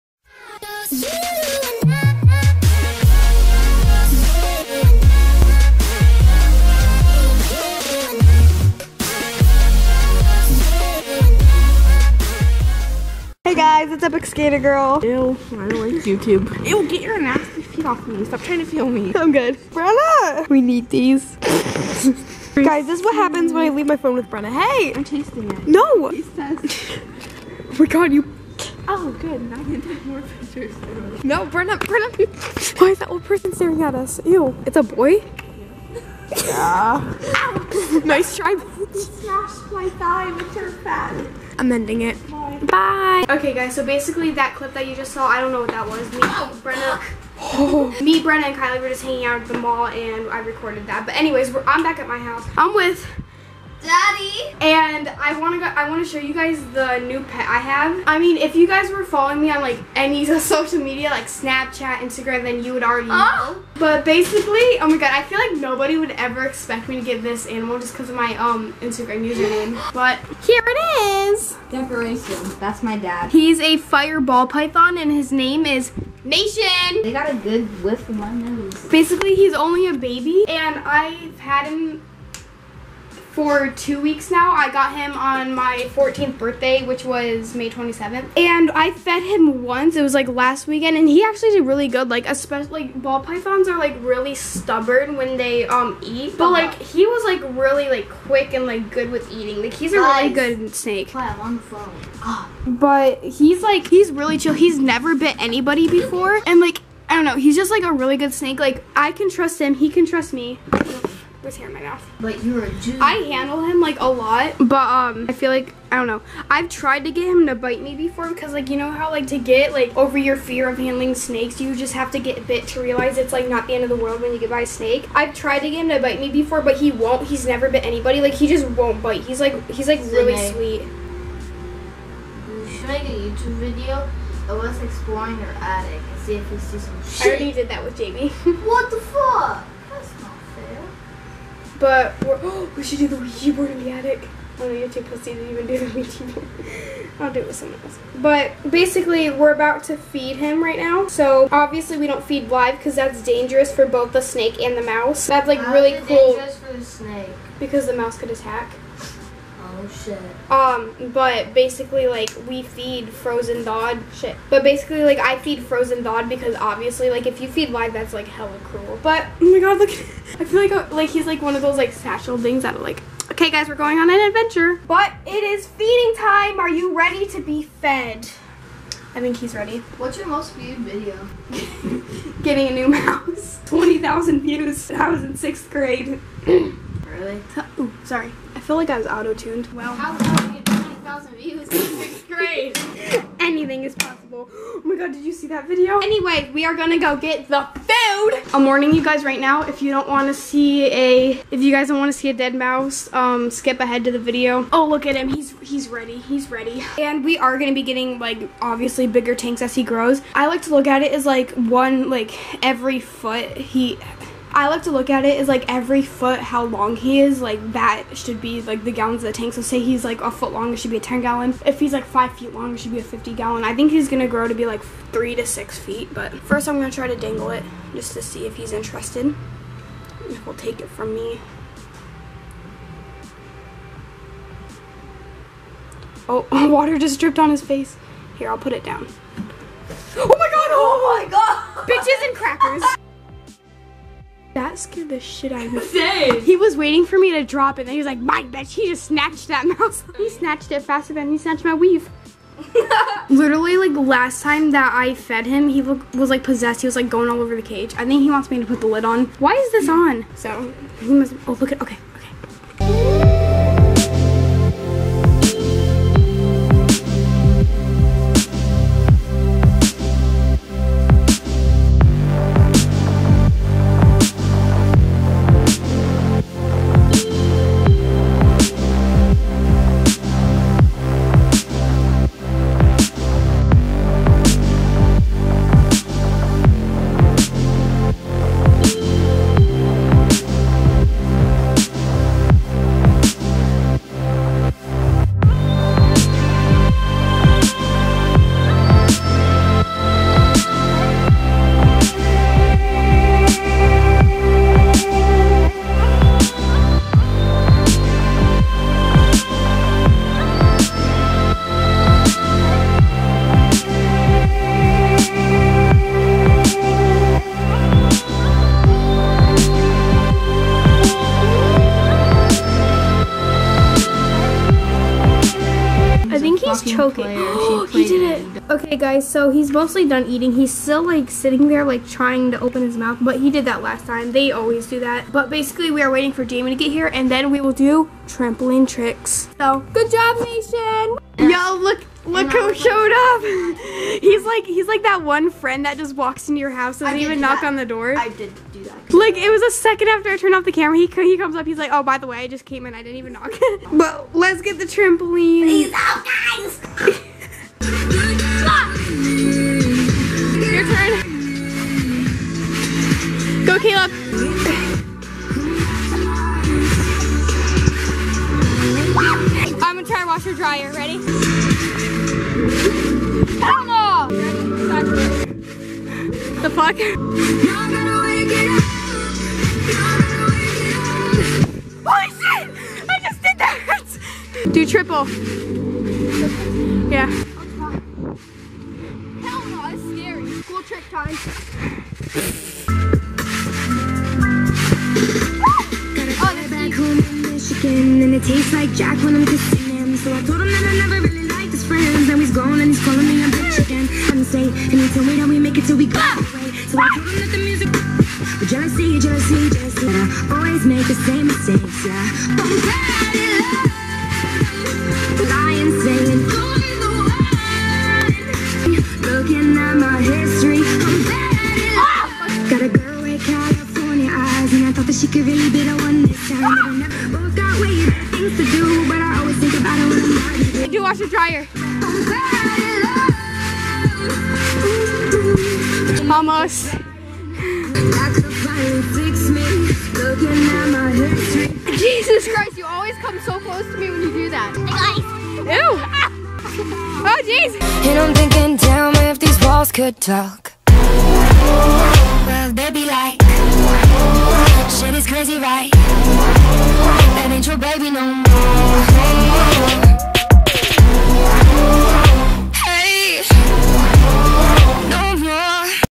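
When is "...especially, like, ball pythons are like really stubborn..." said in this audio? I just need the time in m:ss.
1:32.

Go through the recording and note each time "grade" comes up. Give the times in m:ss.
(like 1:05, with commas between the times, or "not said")
3:05, 3:12.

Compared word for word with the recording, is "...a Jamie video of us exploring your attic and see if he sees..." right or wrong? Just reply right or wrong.
wrong.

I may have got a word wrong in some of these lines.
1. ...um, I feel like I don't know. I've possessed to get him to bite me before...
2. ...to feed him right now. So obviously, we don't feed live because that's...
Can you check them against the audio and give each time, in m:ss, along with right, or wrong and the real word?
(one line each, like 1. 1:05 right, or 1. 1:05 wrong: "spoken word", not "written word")
1. 1:54 wrong: "tried", not "possessed"
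2. 2:29 right.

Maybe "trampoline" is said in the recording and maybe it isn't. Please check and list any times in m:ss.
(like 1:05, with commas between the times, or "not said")
5:38, 5:54.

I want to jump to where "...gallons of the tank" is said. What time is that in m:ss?
3:38.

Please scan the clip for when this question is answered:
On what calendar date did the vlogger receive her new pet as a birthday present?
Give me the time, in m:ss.
1:27.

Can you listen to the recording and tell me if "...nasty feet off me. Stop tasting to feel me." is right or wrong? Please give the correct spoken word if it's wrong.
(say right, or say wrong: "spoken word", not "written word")
wrong: "trying", not "tasting".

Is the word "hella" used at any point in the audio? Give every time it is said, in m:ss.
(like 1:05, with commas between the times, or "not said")
2:48.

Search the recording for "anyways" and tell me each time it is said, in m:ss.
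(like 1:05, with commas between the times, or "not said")
0:51, 3:15.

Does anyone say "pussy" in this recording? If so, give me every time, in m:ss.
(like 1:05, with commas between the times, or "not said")
2:25.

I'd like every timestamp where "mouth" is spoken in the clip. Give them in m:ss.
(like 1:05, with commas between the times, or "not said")
1:51, 5:32.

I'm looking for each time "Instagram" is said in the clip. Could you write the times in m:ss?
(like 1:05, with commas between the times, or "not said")
1:01, 1:08.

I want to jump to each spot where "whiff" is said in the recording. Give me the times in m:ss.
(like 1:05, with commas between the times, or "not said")
1:17.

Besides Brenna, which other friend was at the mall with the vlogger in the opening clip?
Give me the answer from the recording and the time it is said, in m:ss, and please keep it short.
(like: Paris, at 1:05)
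Kylie, at 0:48.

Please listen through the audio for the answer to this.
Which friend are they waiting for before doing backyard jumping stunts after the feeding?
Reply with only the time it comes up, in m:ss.
5:36.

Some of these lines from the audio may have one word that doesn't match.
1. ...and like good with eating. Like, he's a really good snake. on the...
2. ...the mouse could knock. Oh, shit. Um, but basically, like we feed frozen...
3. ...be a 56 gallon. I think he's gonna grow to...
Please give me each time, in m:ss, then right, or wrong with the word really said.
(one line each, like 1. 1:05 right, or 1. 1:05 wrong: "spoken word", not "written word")
1. 1:38 right
2. 2:37 wrong: "attack", not "knock"
3. 3:42 wrong: "50", not "56".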